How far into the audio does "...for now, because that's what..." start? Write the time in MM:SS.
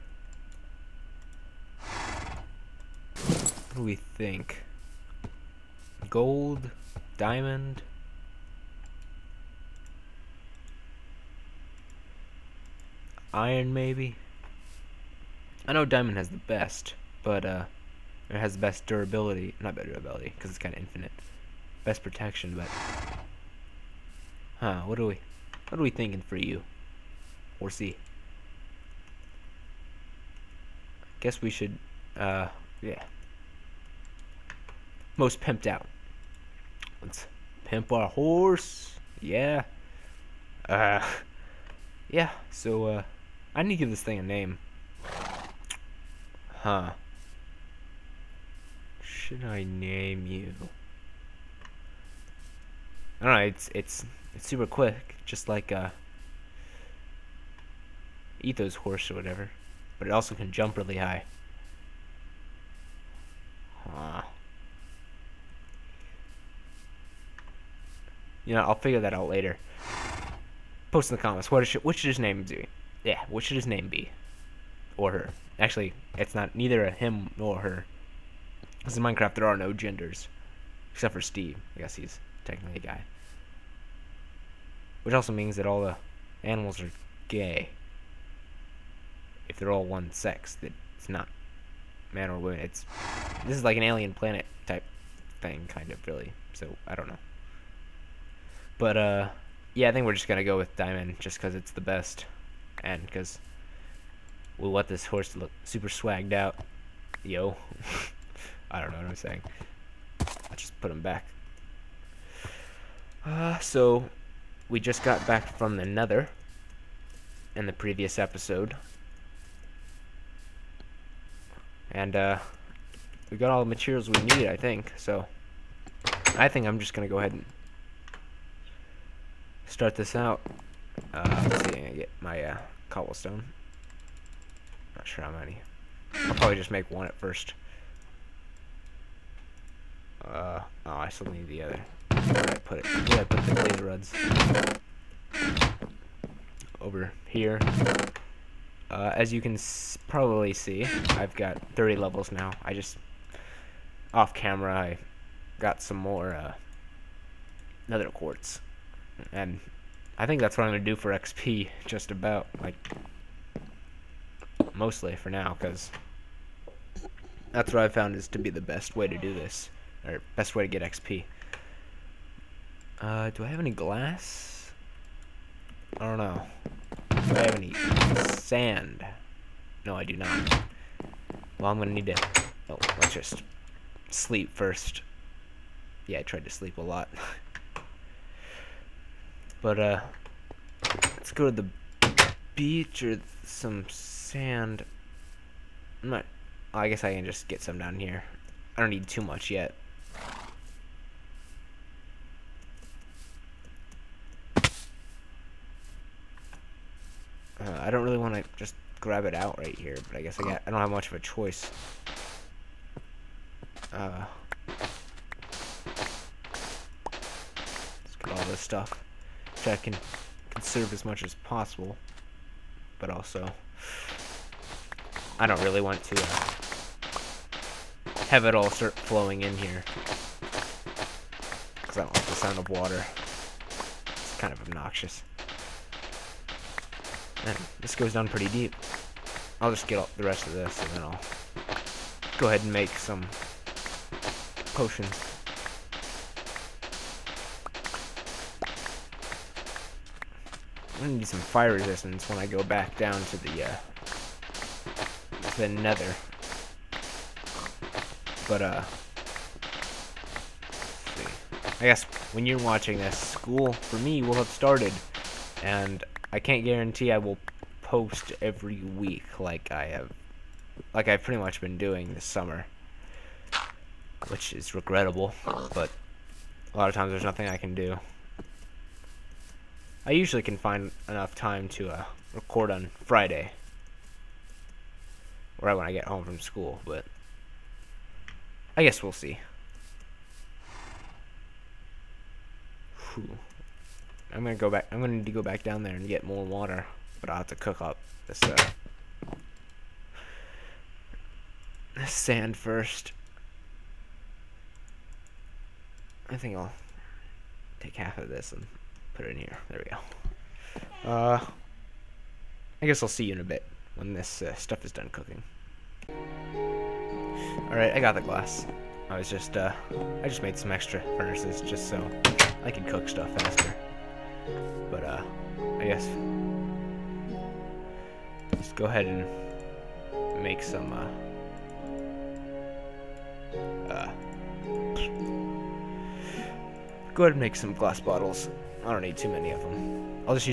02:45.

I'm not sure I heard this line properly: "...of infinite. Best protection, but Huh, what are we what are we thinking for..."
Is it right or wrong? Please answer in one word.
right.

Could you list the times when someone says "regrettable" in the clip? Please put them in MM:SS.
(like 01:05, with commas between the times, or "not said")
04:34.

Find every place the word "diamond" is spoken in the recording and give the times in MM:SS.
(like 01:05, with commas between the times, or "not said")
00:07, 00:15, 01:40.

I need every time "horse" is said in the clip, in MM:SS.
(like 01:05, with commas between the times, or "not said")
00:38, 00:58, 01:45.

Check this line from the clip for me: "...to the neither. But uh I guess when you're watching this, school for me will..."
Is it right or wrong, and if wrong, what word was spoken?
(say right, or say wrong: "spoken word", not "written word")
wrong: "nether", not "neither".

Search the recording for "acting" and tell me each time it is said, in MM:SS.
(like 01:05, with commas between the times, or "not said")
not said.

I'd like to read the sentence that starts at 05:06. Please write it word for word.
I think I'll take half of this and put it in here.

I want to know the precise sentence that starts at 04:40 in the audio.
I usually can find enough time to uh, record on Friday.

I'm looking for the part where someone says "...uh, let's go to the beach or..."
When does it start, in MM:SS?
03:09.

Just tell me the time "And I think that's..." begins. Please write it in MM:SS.
02:39.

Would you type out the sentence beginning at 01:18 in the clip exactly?
Because in Minecraft, there are no genders.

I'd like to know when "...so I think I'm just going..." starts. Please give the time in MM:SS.
02:04.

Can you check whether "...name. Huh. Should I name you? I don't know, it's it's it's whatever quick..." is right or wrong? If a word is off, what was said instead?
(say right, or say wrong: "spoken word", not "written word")
wrong: "super", not "whatever".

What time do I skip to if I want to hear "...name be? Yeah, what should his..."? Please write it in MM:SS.
01:12.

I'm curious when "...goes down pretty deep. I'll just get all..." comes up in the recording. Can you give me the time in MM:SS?
03:57.